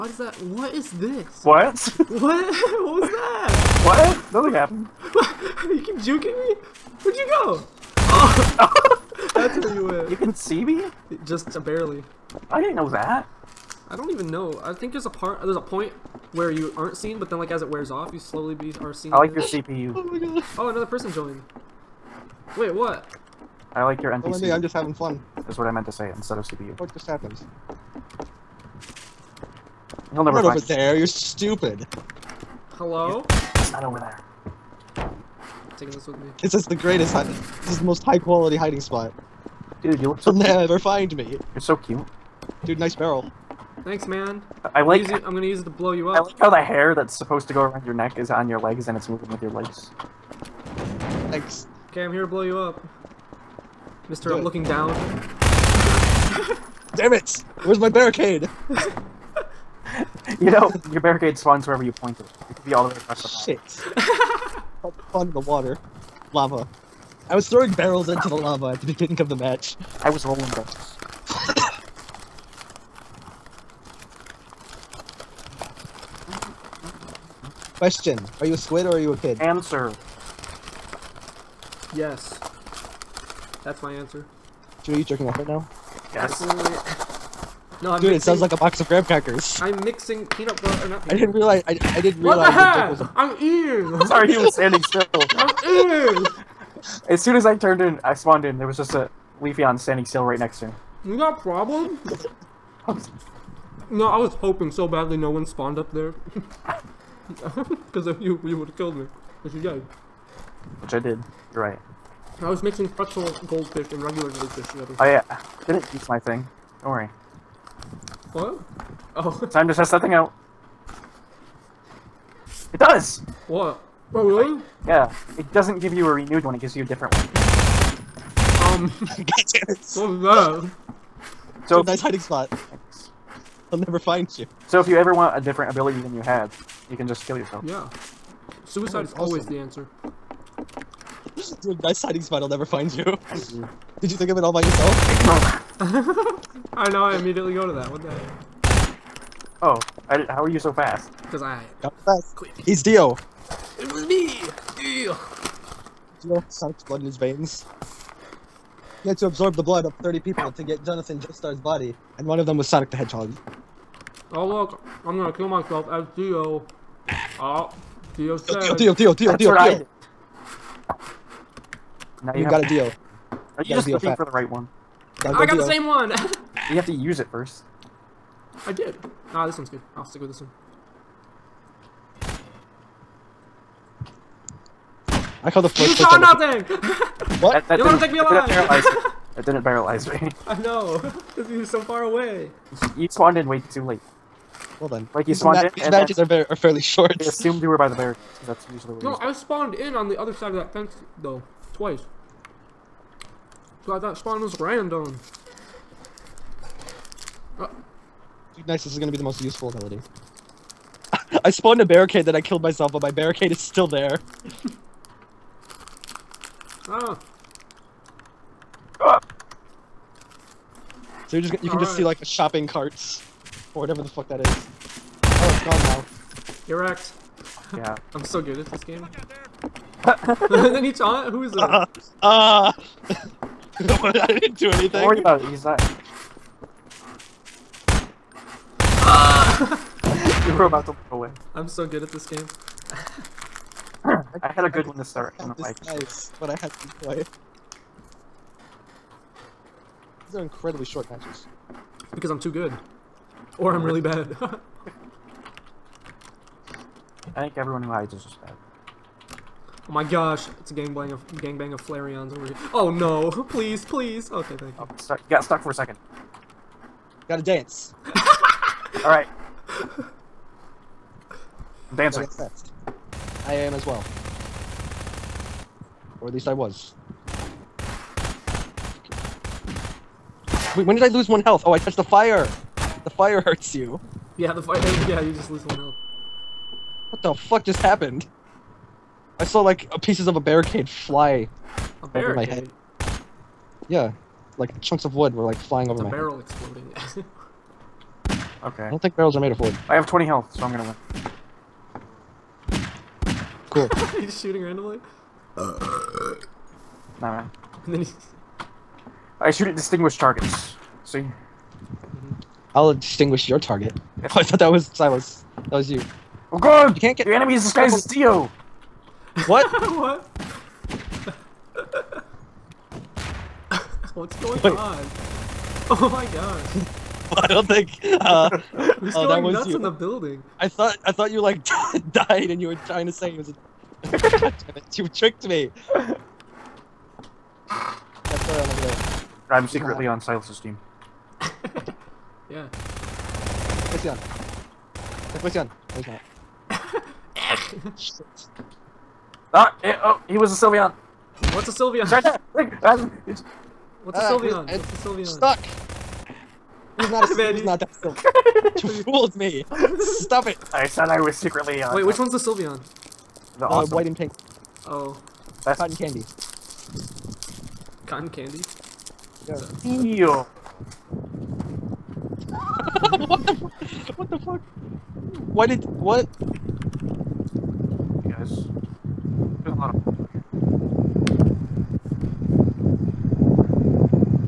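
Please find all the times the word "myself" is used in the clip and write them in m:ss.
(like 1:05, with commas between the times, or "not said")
2:45, 3:32.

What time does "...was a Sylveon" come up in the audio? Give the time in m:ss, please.
5:50.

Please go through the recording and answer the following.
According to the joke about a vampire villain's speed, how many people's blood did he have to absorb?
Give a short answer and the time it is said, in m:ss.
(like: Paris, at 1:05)
30, at 2:40.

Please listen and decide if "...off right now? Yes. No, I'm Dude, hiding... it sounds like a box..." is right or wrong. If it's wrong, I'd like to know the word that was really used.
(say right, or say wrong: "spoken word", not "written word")
wrong: "mixing", not "hiding".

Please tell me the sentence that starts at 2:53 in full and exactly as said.
Are you, you just looking for the right one?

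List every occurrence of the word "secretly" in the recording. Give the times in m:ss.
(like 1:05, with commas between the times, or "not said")
5:39, 6:01.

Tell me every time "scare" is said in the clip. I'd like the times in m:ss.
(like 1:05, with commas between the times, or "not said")
not said.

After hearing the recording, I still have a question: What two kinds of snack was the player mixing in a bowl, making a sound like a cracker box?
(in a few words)
pretzel goldfish and regular goldfish.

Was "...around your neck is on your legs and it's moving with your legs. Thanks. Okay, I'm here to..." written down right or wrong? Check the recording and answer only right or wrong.
right.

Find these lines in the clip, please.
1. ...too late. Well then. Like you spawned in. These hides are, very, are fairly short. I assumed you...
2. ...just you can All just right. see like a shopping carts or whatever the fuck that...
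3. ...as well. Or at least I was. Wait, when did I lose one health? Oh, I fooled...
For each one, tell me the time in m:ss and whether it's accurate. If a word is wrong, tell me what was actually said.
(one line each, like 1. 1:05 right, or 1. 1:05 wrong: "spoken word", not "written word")
1. 3:13 wrong: "matches", not "hides"
2. 3:41 right
3. 4:33 wrong: "touched", not "fooled".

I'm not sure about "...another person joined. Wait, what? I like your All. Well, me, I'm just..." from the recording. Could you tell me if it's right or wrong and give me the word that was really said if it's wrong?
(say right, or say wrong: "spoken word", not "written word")
wrong: "NPC", not "All".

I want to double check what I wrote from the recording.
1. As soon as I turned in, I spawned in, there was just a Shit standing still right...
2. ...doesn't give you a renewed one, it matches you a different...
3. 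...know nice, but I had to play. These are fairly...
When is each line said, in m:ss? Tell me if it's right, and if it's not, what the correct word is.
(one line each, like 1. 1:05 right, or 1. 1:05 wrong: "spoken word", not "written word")
1. 1:37 wrong: "Leafeon", not "Shit"
2. 2:05 wrong: "gives", not "matches"
3. 4:05 wrong: "incredibly", not "fairly".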